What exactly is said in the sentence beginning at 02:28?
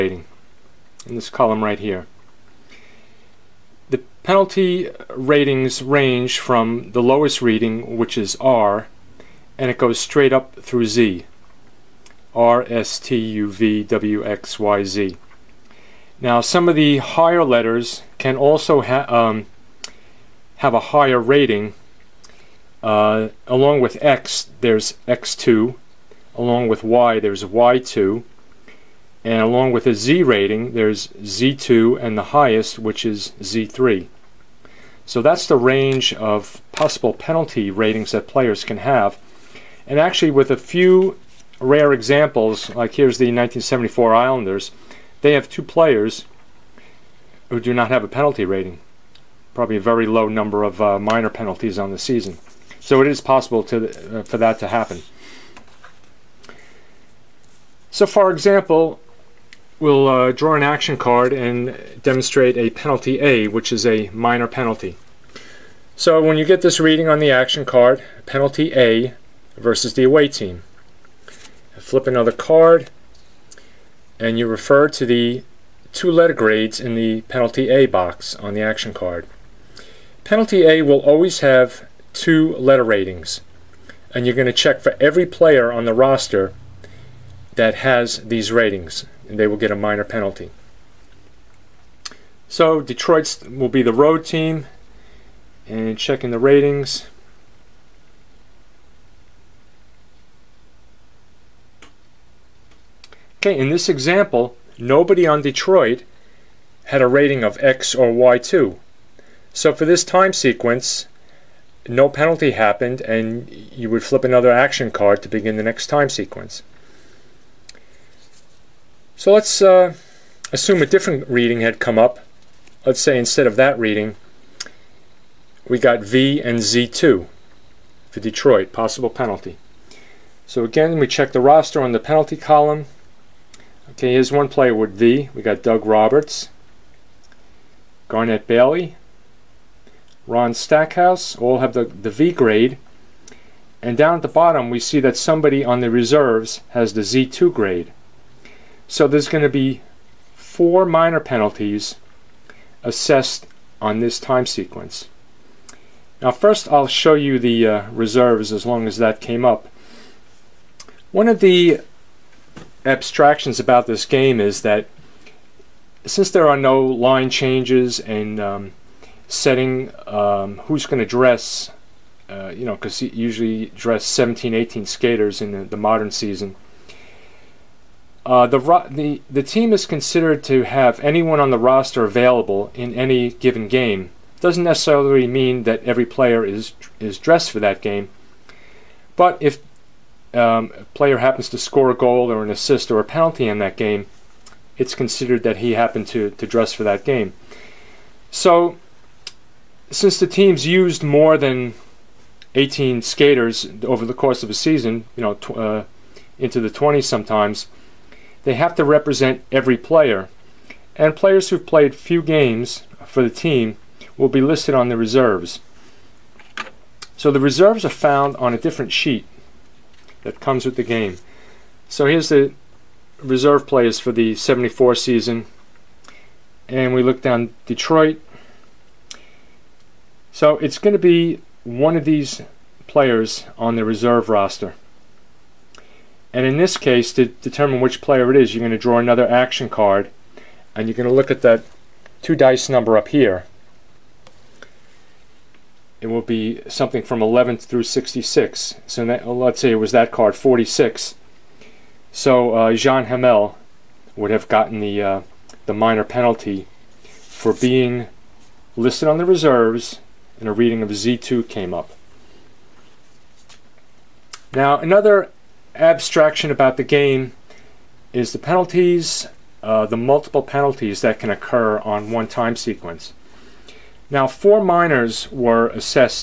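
So there's going to be four minor penalties assessed on this time sequence.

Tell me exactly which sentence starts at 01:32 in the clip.
So Detroit will be the road team, and checking the ratings.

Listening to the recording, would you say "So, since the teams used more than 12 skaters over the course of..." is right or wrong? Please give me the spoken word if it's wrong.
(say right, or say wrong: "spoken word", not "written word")
wrong: "18", not "12".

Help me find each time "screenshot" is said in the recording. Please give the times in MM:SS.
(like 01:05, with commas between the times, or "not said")
not said.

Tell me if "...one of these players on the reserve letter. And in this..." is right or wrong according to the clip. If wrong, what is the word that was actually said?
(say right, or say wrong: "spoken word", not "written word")
wrong: "roster", not "letter".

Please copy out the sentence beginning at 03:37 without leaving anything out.
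So the reserves are found on a different sheet that comes with the game.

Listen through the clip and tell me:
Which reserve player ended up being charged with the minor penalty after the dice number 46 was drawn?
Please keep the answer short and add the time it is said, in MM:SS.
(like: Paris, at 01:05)
Jean Hamel, at 04:12.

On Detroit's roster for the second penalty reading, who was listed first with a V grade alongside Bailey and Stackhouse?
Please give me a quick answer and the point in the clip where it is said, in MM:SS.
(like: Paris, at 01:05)
Doug Roberts, at 02:15.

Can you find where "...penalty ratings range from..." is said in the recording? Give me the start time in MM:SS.
00:04.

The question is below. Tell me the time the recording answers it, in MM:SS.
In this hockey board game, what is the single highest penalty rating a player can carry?
00:33.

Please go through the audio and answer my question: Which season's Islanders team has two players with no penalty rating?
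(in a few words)
1974.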